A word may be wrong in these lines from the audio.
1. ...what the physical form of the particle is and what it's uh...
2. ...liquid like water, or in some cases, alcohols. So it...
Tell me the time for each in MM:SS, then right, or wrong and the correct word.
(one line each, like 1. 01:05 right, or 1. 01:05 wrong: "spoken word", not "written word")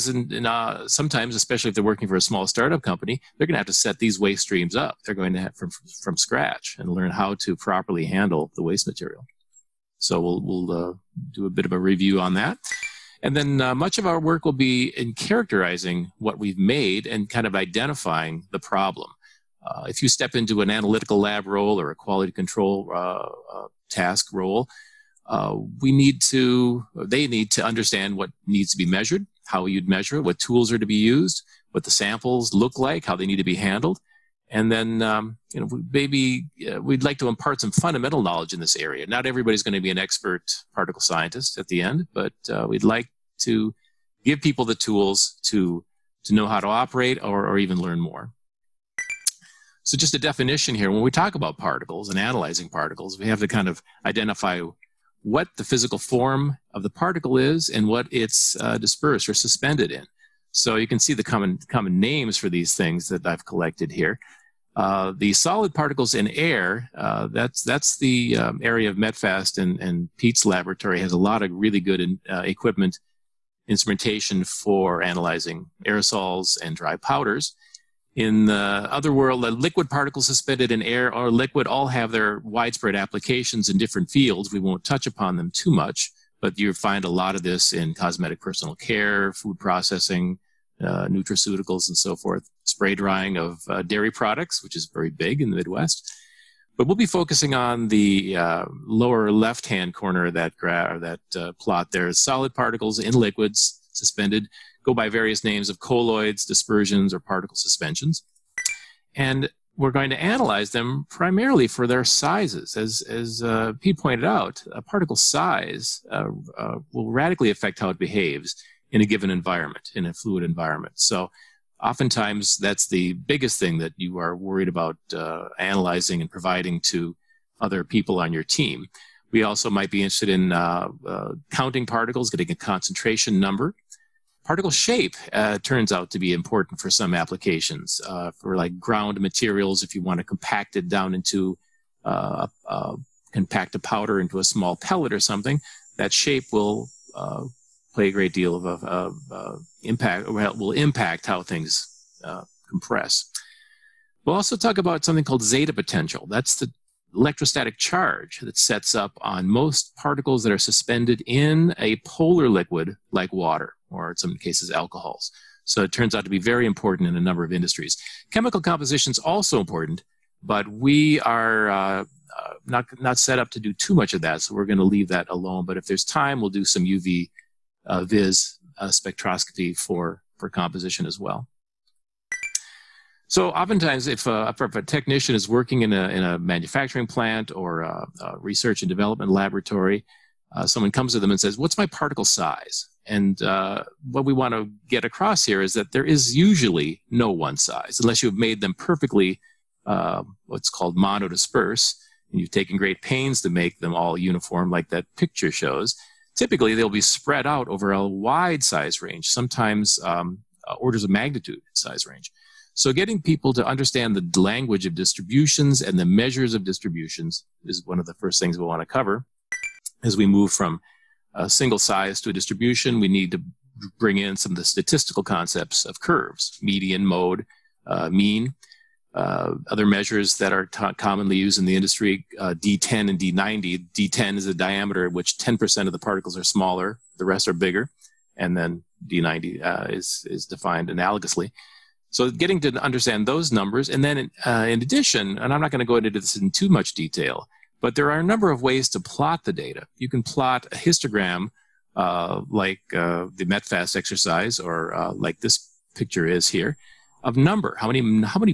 1. 00:55 right
2. 02:42 right.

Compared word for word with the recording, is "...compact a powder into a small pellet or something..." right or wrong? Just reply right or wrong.
right.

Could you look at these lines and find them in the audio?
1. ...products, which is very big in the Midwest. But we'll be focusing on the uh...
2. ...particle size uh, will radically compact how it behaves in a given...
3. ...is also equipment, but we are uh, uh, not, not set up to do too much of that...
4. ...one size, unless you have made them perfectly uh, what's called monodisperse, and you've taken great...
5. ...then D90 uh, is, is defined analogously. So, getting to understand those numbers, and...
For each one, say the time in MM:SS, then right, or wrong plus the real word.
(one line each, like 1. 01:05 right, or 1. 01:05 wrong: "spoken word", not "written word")
1. 01:34 right
2. 01:54 wrong: "affect", not "compact"
3. 02:49 wrong: "important", not "equipment"
4. 03:17 right
5. 03:58 right.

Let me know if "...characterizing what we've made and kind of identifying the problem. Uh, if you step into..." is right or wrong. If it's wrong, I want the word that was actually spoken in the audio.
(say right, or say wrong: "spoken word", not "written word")
right.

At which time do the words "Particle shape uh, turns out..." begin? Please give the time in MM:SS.
02:14.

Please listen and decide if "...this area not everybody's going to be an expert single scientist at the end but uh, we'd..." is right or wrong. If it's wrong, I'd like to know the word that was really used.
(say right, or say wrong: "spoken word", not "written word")
wrong: "particle", not "single".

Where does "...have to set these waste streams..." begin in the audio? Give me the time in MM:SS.
00:03.